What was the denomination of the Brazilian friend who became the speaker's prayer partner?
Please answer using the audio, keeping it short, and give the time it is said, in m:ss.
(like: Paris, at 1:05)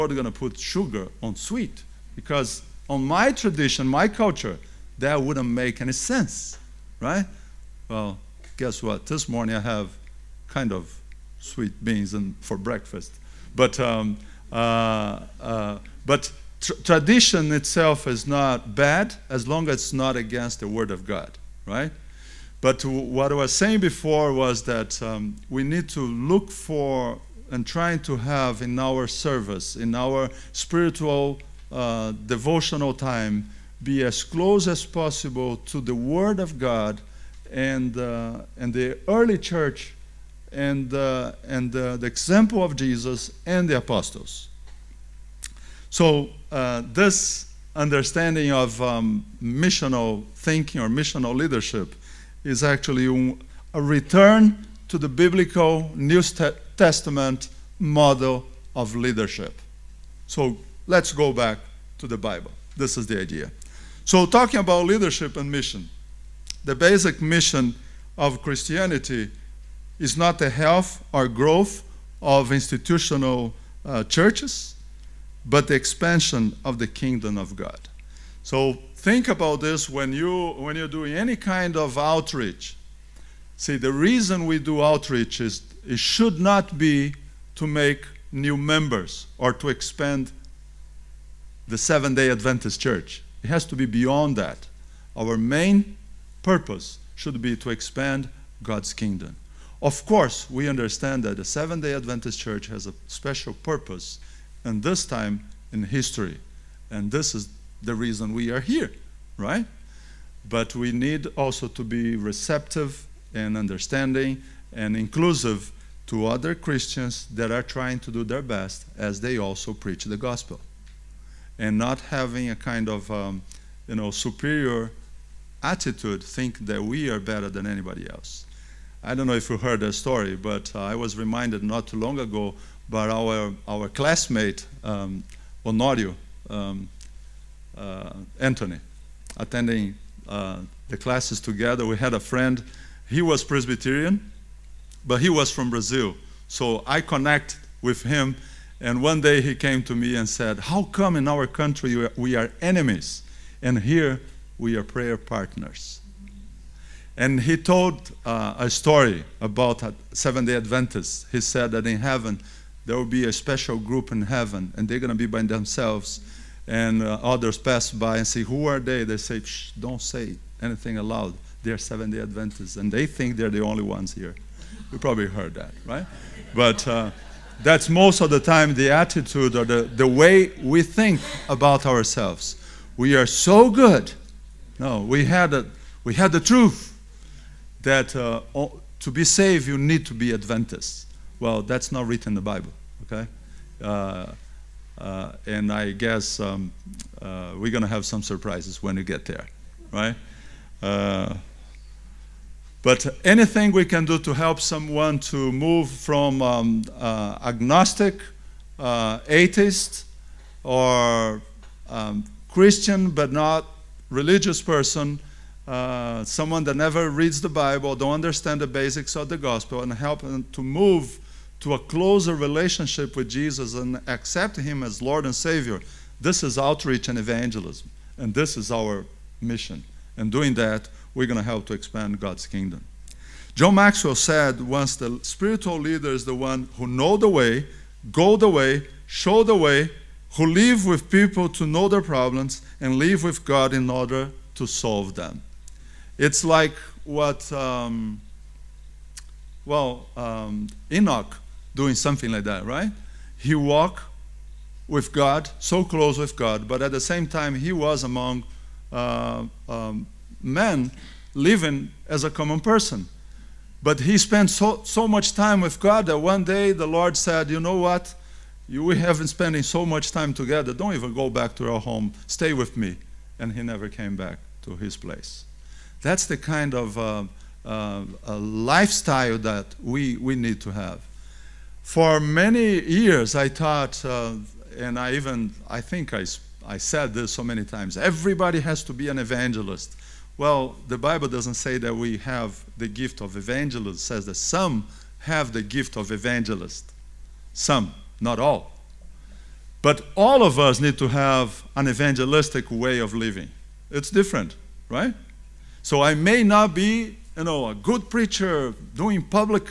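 Presbyterian, at 2:23.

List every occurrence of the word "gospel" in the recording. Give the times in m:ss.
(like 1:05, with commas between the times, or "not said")
2:00, 3:39.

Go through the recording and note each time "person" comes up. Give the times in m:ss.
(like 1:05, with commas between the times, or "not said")
3:34, 4:22.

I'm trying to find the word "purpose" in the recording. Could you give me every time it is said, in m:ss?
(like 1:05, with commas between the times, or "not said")
1:36, 1:43.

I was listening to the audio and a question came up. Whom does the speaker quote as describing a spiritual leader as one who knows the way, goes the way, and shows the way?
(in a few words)
John Maxwell.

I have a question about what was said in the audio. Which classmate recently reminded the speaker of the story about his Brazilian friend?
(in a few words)
Honorio.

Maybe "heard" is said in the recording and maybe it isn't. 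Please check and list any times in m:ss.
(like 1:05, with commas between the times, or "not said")
2:09, 2:55.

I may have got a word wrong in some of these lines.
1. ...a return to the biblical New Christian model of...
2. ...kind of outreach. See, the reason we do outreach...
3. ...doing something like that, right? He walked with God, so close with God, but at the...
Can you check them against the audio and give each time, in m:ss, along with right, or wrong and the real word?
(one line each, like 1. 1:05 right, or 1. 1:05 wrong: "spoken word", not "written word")
1. 0:53 wrong: "Testament", not "Christian"
2. 1:21 right
3. 4:11 right.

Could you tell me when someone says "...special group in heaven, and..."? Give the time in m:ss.
2:43.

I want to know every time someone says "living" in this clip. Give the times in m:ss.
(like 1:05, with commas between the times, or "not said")
4:21, 5:03.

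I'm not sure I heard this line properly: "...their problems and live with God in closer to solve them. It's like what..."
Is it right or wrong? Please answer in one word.
wrong.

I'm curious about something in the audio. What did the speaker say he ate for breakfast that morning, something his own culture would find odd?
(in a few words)
sweet beans.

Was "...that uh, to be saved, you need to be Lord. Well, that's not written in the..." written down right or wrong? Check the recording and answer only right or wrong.
wrong.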